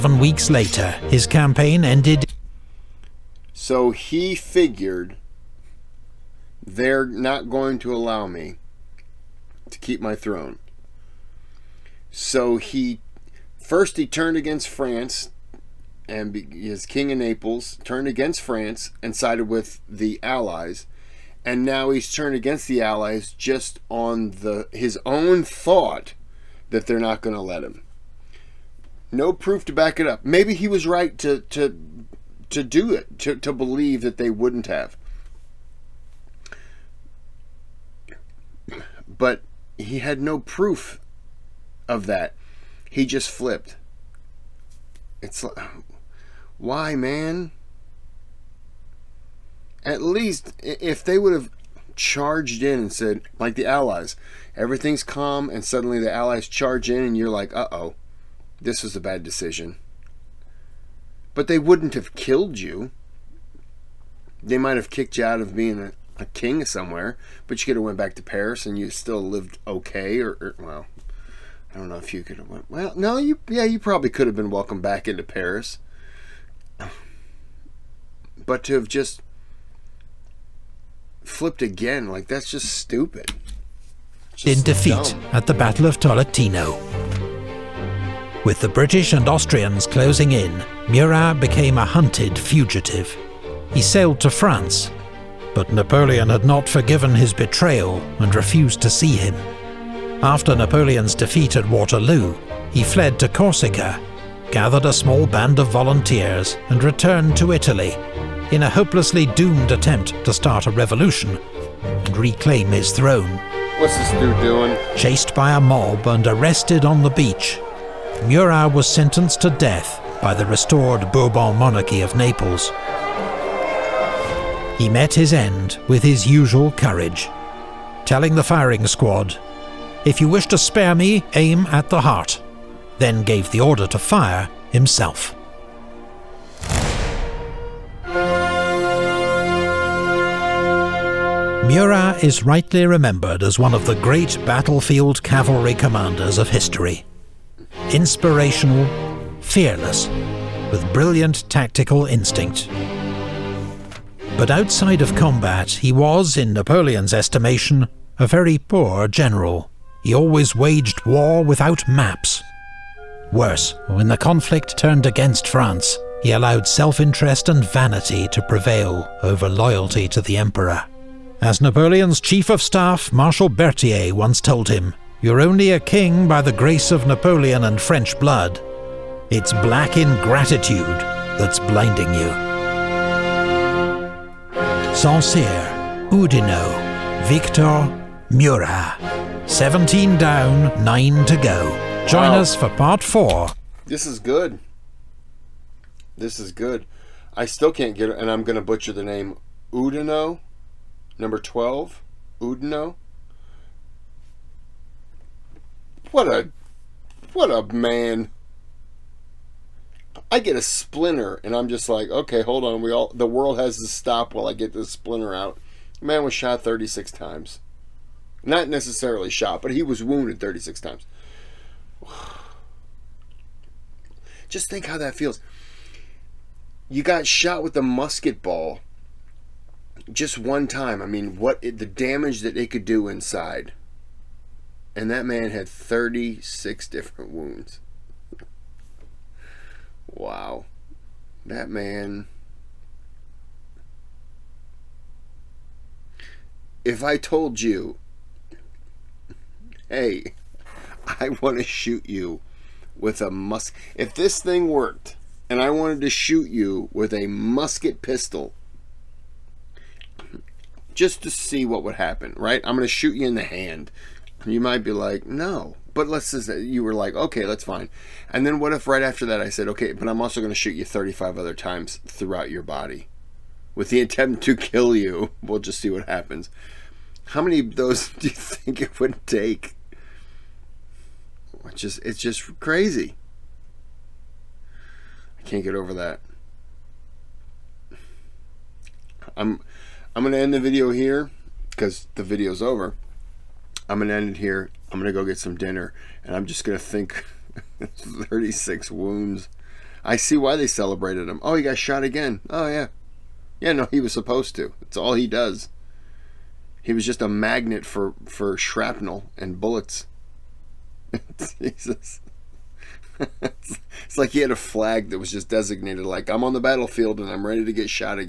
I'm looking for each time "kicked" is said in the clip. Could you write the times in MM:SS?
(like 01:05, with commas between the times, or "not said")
01:04.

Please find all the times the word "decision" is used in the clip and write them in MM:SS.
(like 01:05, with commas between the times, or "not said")
00:59.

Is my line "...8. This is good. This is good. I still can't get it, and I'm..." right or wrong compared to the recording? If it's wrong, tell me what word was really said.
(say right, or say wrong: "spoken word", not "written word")
wrong: "4", not "8".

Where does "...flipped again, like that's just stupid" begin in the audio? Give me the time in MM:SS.
01:21.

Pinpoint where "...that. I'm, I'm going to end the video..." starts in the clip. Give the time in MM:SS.
04:45.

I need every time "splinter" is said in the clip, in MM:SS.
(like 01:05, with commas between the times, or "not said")
03:30, 03:34.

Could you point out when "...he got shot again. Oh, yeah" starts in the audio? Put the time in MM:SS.
05:01.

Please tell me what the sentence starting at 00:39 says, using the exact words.
But he had no proof of that.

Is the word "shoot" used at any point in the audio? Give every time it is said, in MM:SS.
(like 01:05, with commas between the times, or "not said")
04:11, 04:16, 04:22, 04:30.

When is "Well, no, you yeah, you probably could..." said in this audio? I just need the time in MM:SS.
01:12.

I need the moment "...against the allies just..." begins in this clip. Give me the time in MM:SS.
00:22.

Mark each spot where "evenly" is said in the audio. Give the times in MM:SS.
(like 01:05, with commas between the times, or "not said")
not said.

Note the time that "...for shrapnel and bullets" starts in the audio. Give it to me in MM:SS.
05:08.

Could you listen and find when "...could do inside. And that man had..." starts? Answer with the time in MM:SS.
03:52.